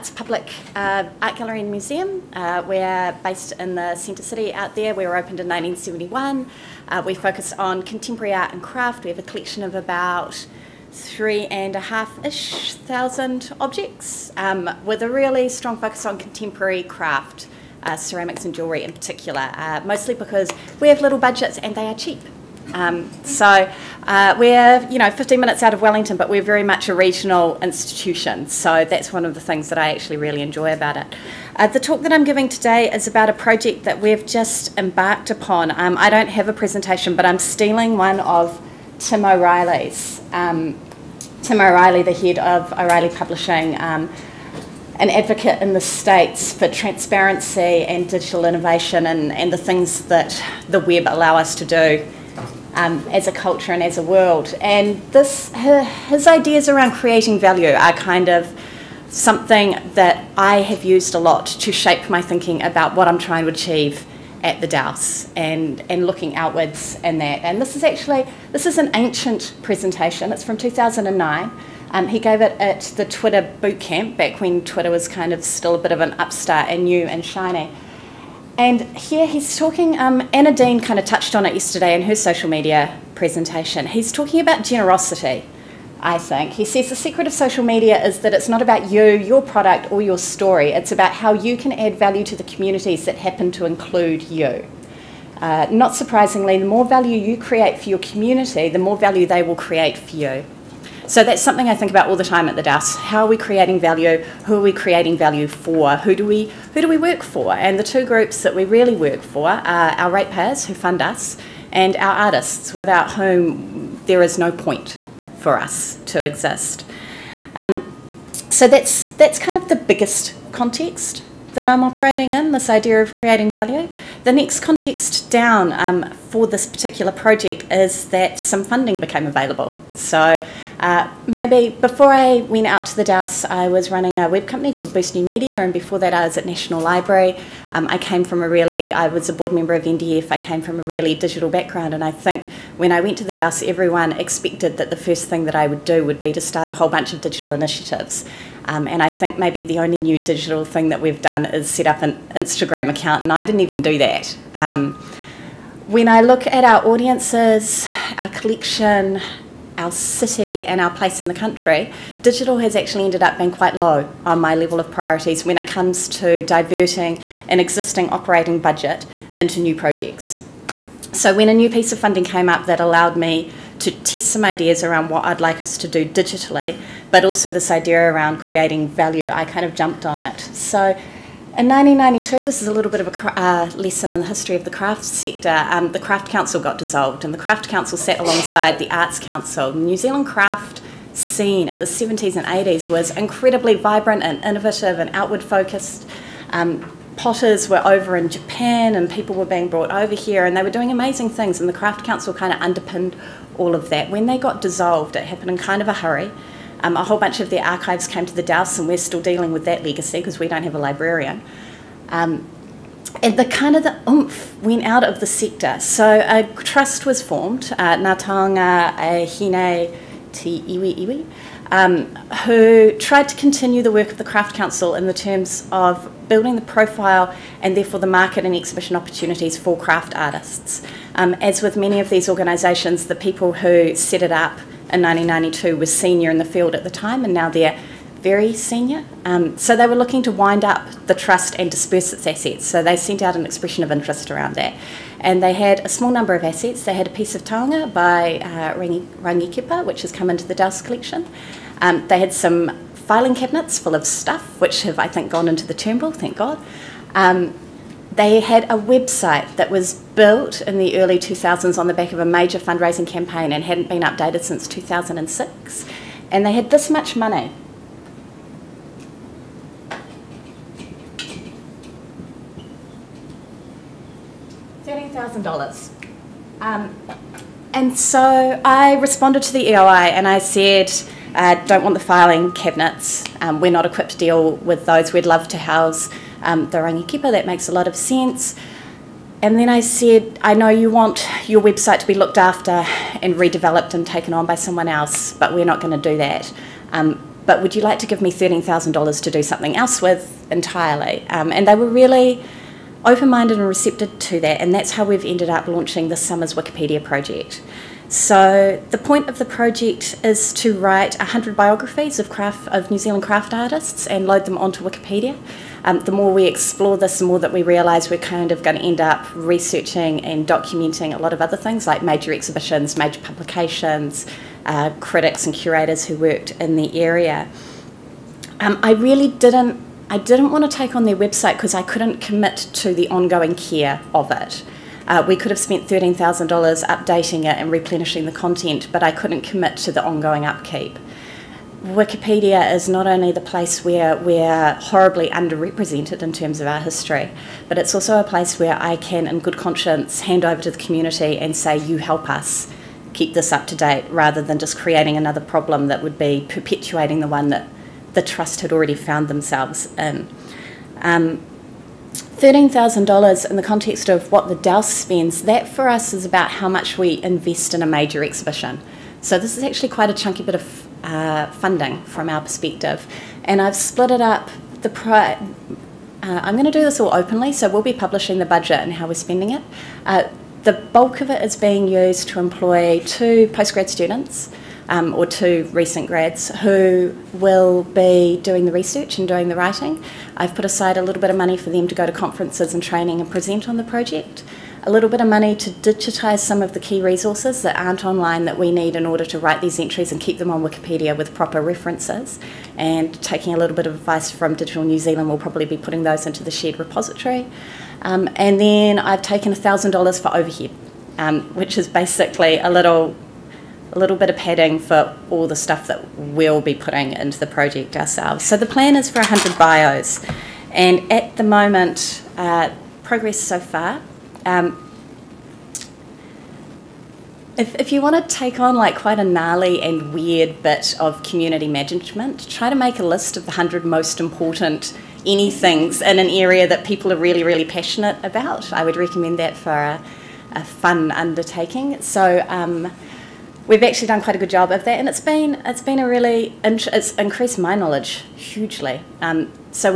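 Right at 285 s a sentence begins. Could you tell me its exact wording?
We'd love to house um, the Rangi Kipa.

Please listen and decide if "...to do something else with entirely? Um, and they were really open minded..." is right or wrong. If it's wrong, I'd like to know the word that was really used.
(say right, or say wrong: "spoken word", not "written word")
right.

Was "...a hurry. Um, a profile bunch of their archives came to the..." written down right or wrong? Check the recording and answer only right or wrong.
wrong.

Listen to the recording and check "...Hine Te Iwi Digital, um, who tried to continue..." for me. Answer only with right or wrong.
wrong.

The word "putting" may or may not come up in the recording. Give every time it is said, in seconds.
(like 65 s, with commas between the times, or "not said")
405 s, 416 s.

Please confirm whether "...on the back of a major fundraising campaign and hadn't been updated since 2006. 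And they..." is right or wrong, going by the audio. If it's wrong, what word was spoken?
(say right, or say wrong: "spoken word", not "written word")
right.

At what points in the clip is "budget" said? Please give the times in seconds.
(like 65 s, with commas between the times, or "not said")
21 s, 168 s, 378 s.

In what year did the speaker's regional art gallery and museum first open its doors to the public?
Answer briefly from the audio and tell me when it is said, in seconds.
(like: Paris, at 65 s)
1971, at 5 s.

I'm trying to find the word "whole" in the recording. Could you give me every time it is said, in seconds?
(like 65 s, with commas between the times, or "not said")
146 s, 207 s.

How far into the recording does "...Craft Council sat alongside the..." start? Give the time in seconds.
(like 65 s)
187 s.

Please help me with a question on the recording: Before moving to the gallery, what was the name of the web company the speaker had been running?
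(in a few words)
Boost New Media.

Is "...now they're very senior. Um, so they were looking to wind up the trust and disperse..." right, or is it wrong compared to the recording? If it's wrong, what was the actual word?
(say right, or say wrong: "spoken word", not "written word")
right.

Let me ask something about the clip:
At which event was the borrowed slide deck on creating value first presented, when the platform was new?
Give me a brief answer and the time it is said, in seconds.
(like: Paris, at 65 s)
Twitter boot camp, at 73 s.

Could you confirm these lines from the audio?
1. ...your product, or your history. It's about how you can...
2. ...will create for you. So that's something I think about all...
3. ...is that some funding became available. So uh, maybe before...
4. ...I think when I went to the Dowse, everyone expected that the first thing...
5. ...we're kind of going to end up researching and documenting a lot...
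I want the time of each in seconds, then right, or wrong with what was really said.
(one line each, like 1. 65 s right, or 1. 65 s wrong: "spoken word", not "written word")
1. 89 s wrong: "story", not "history"
2. 99 s right
3. 127 s right
4. 142 s right
5. 318 s right.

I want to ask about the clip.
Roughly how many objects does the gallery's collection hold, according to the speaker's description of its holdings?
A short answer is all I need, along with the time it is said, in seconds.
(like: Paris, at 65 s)
3,500, at 10 s.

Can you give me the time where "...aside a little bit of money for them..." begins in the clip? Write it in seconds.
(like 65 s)
390 s.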